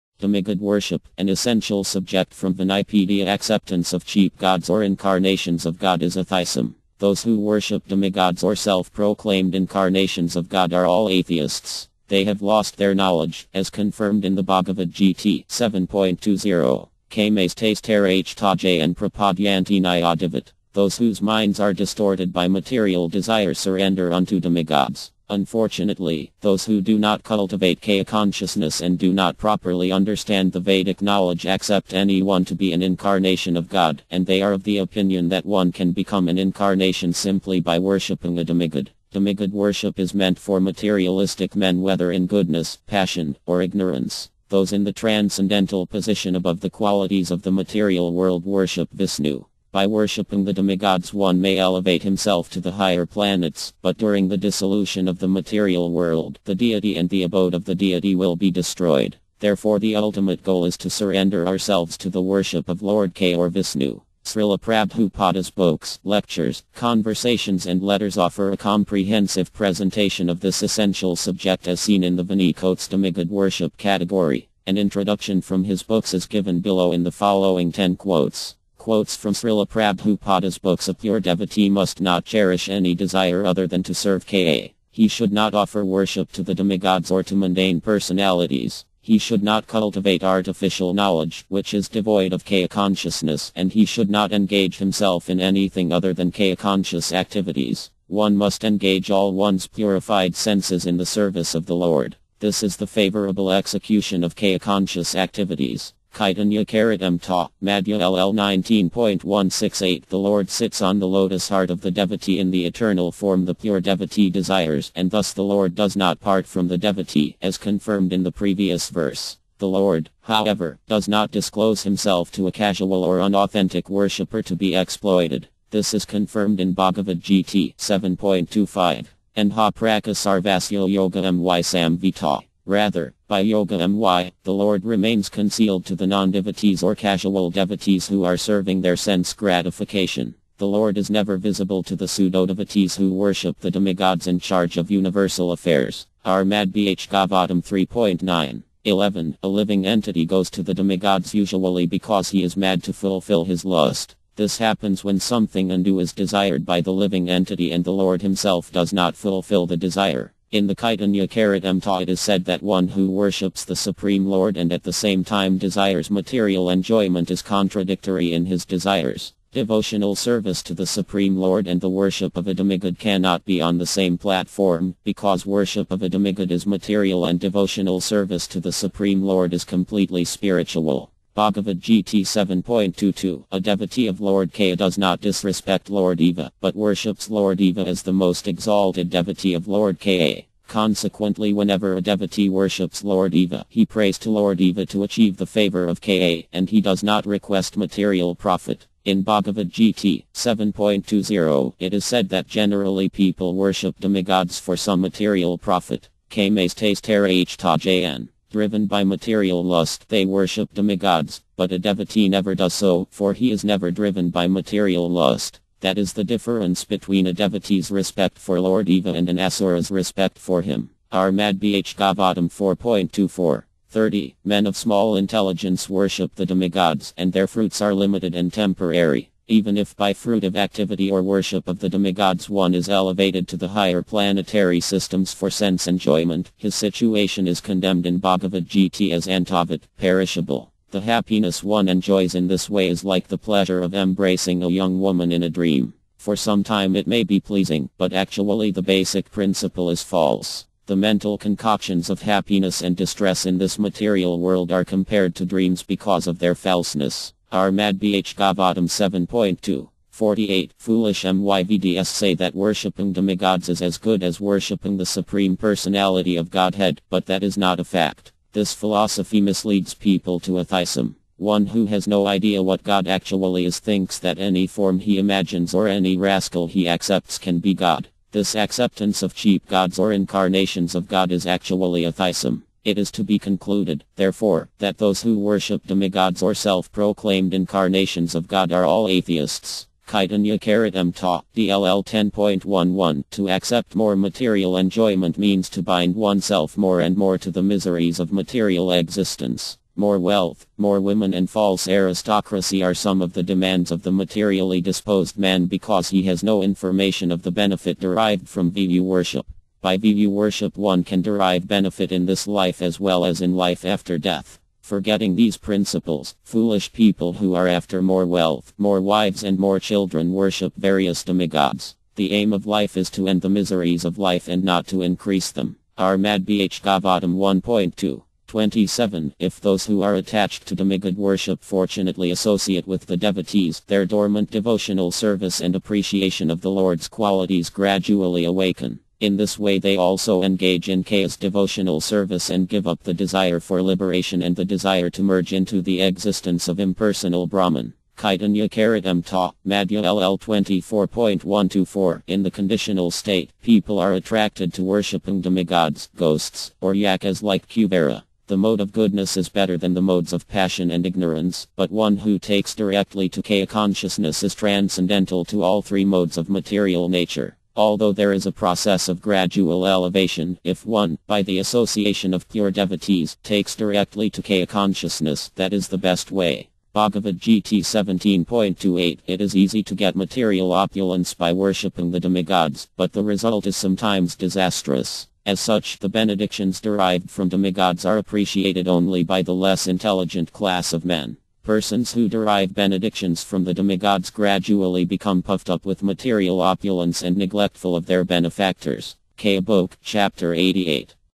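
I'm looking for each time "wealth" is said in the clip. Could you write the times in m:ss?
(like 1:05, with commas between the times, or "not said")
5:00, 5:18.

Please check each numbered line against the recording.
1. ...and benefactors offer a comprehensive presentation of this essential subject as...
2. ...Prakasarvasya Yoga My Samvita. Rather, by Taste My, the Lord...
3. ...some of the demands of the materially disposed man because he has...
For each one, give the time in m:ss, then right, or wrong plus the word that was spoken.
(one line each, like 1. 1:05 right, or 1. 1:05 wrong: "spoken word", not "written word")
1. 1:07 wrong: "letters", not "benefactors"
2. 2:09 wrong: "Yoga", not "Taste"
3. 5:02 right.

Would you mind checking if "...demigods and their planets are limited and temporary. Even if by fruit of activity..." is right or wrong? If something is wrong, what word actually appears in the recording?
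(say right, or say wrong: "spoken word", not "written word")
wrong: "fruits", not "planets".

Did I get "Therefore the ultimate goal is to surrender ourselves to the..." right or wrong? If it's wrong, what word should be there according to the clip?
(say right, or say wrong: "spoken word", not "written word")
right.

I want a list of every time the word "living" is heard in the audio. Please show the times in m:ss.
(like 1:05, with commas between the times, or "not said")
2:29, 2:36.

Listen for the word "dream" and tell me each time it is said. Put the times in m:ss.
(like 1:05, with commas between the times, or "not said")
4:05, 4:15.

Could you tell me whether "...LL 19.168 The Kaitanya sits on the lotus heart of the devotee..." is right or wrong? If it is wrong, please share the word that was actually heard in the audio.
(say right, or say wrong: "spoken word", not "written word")
wrong: "Lord", not "Kaitanya".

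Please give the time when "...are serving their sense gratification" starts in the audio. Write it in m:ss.
2:18.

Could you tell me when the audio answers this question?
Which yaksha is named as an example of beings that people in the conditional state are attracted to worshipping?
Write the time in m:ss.
5:57.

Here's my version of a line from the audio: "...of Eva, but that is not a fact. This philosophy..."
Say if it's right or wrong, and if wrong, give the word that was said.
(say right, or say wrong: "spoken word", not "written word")
wrong: "Godhead", not "Eva".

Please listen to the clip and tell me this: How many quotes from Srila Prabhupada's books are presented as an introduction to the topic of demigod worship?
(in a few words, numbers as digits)
10.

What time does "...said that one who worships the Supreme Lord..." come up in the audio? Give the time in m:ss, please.
2:42.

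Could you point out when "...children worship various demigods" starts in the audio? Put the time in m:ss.
5:19.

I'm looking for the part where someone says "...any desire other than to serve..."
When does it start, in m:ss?
1:22.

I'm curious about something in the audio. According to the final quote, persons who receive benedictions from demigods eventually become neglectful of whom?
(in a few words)
Their benefactors.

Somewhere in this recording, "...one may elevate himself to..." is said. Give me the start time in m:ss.
0:51.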